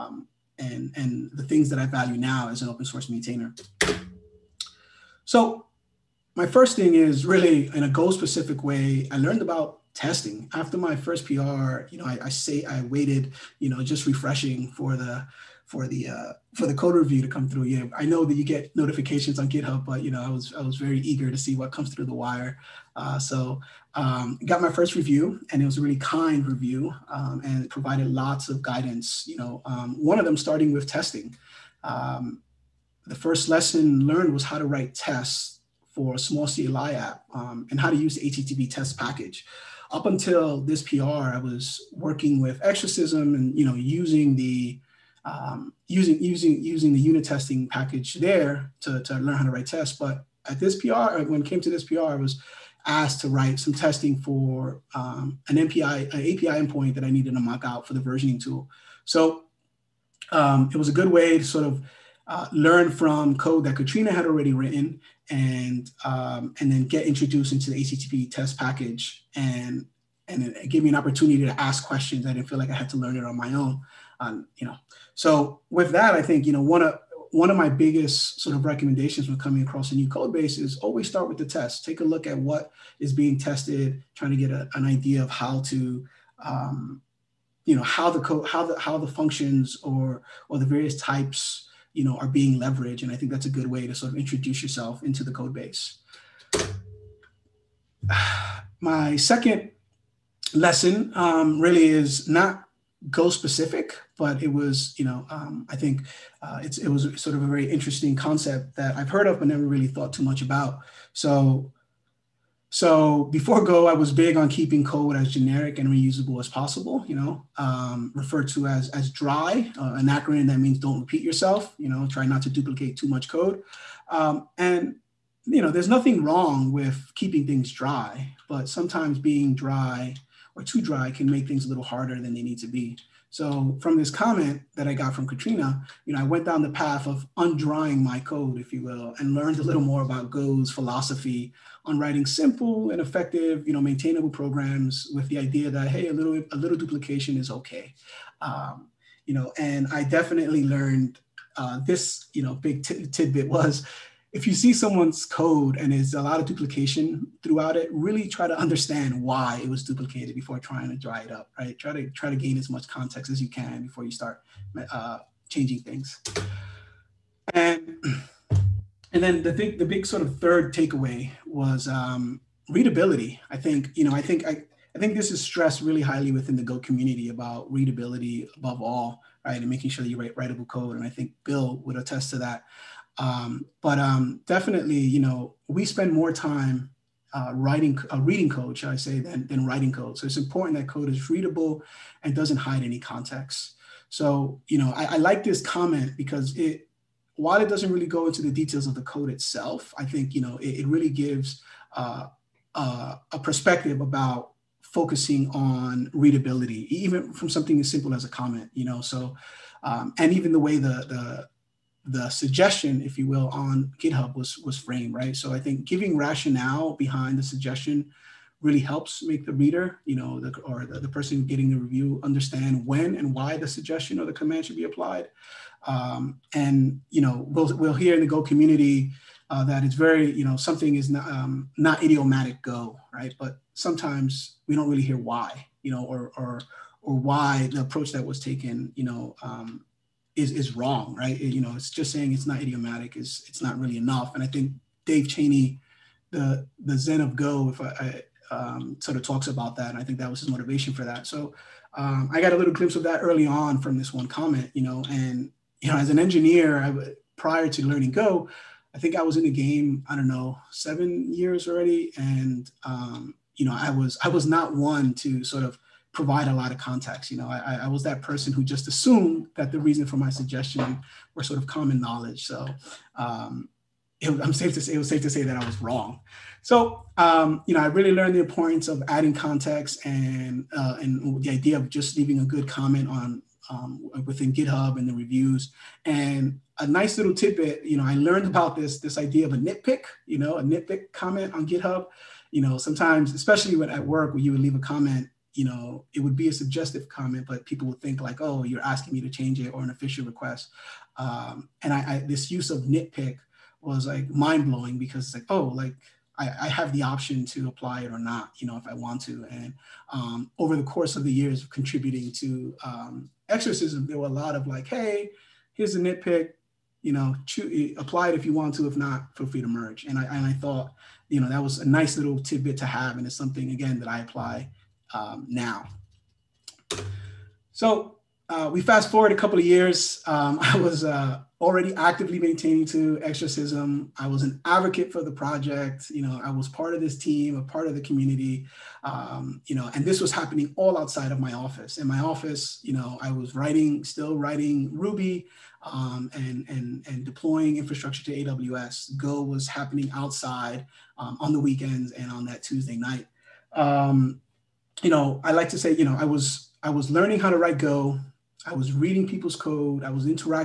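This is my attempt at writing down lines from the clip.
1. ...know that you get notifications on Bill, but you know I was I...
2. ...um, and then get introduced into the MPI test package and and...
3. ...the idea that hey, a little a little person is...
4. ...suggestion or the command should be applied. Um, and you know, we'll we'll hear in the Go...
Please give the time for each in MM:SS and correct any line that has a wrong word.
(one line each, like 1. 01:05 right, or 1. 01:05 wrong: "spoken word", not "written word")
1. 00:18 wrong: "GitHub", not "Bill"
2. 01:06 wrong: "HTTP", not "MPI"
3. 02:25 wrong: "duplication", not "person"
4. 03:43 right.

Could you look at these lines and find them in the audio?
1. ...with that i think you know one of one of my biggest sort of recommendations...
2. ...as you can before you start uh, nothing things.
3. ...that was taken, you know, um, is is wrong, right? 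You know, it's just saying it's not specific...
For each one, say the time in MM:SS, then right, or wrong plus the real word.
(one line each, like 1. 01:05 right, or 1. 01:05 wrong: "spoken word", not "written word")
1. 01:15 right
2. 02:43 wrong: "changing", not "nothing"
3. 03:58 wrong: "idiomatic", not "specific".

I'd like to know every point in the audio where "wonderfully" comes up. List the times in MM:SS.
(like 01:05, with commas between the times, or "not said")
not said.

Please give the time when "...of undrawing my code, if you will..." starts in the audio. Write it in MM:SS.
02:17.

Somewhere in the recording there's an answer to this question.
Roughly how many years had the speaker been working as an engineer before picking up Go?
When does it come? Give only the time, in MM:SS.
04:20.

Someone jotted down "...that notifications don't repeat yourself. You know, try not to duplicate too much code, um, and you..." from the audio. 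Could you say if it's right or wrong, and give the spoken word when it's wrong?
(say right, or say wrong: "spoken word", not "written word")
wrong: "means", not "notifications".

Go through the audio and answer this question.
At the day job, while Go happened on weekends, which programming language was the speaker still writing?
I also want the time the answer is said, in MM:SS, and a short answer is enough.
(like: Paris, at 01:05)
Ruby, at 05:44.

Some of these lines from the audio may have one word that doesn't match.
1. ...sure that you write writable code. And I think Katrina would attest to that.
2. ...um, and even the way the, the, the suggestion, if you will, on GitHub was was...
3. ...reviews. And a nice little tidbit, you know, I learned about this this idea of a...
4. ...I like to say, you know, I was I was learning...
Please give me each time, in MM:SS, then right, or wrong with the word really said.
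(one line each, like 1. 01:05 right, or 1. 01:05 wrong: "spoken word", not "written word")
1. 02:59 wrong: "Bill", not "Katrina"
2. 03:29 right
3. 04:45 right
4. 05:55 right.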